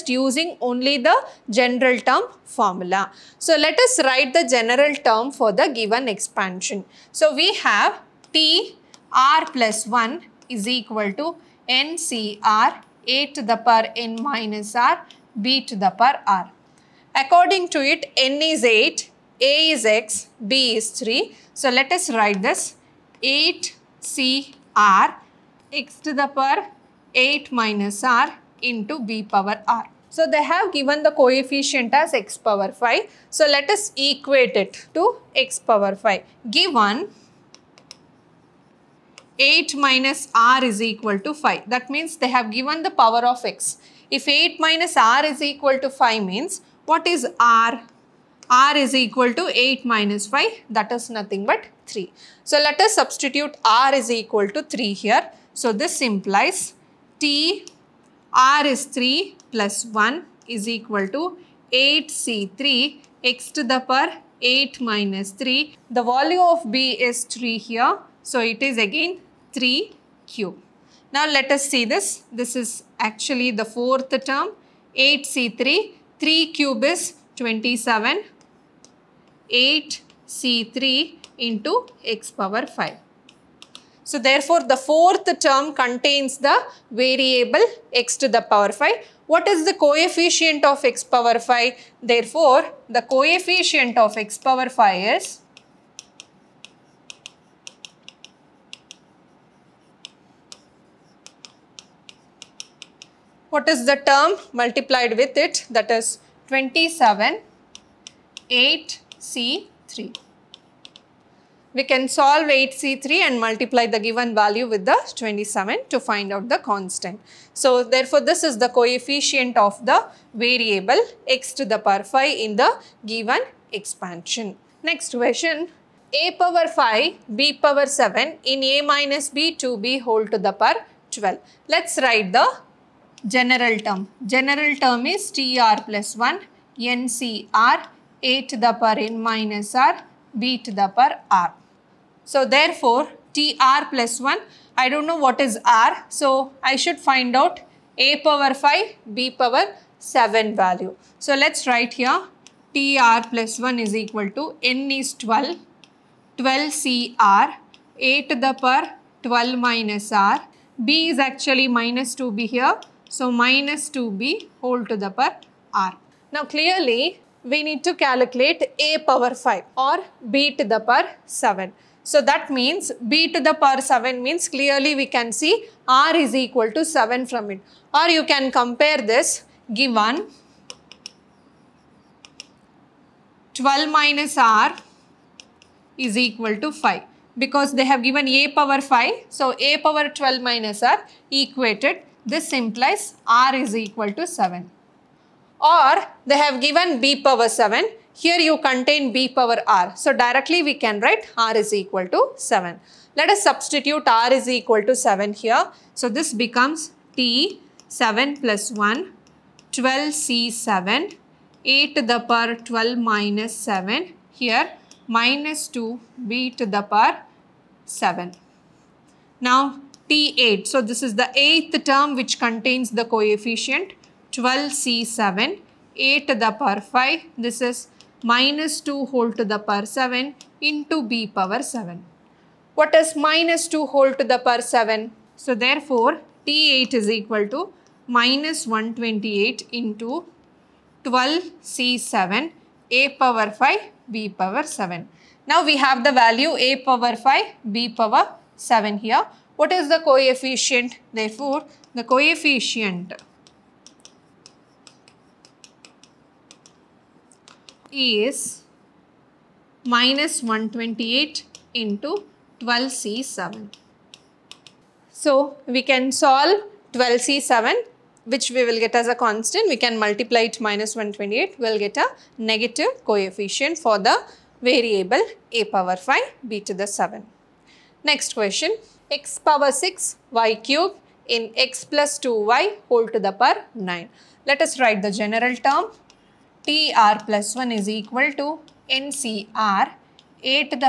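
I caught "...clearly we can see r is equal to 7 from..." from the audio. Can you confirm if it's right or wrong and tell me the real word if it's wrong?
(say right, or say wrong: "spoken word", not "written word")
right.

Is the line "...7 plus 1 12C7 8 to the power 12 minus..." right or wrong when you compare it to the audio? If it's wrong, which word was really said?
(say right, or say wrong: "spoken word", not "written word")
right.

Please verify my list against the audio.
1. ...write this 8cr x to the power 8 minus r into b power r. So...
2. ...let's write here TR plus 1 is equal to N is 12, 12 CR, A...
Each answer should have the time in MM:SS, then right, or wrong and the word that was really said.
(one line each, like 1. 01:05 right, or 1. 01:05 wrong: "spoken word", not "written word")
1. 00:22 right
2. 02:31 right.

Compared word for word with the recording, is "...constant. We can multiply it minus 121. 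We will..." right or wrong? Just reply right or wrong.
wrong.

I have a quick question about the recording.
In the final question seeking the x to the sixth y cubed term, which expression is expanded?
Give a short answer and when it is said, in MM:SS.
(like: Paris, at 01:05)
(x + 2y)^9, at 04:41.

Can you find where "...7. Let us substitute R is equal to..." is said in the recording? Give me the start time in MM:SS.
03:22.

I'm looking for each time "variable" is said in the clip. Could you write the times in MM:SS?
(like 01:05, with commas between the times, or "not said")
01:26, 02:00, 04:34.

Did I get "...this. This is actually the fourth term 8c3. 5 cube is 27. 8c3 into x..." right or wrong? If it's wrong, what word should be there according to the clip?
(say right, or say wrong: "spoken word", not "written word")
wrong: "3", not "5".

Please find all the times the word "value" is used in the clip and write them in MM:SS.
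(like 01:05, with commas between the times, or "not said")
01:06, 01:54, 02:30, 04:06.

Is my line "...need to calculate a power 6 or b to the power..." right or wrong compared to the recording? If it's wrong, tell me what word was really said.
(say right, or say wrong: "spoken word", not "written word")
wrong: "5", not "6".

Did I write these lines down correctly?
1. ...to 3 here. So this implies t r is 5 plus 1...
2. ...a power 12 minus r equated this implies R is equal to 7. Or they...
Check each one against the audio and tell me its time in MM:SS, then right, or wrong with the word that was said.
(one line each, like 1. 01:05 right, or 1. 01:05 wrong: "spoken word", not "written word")
1. 00:54 wrong: "3", not "5"
2. 03:09 right.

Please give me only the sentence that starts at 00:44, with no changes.
If 8 minus r is equal to 5 means what is r?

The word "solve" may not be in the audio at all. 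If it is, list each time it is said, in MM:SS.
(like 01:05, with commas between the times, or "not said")
01:52, 04:26.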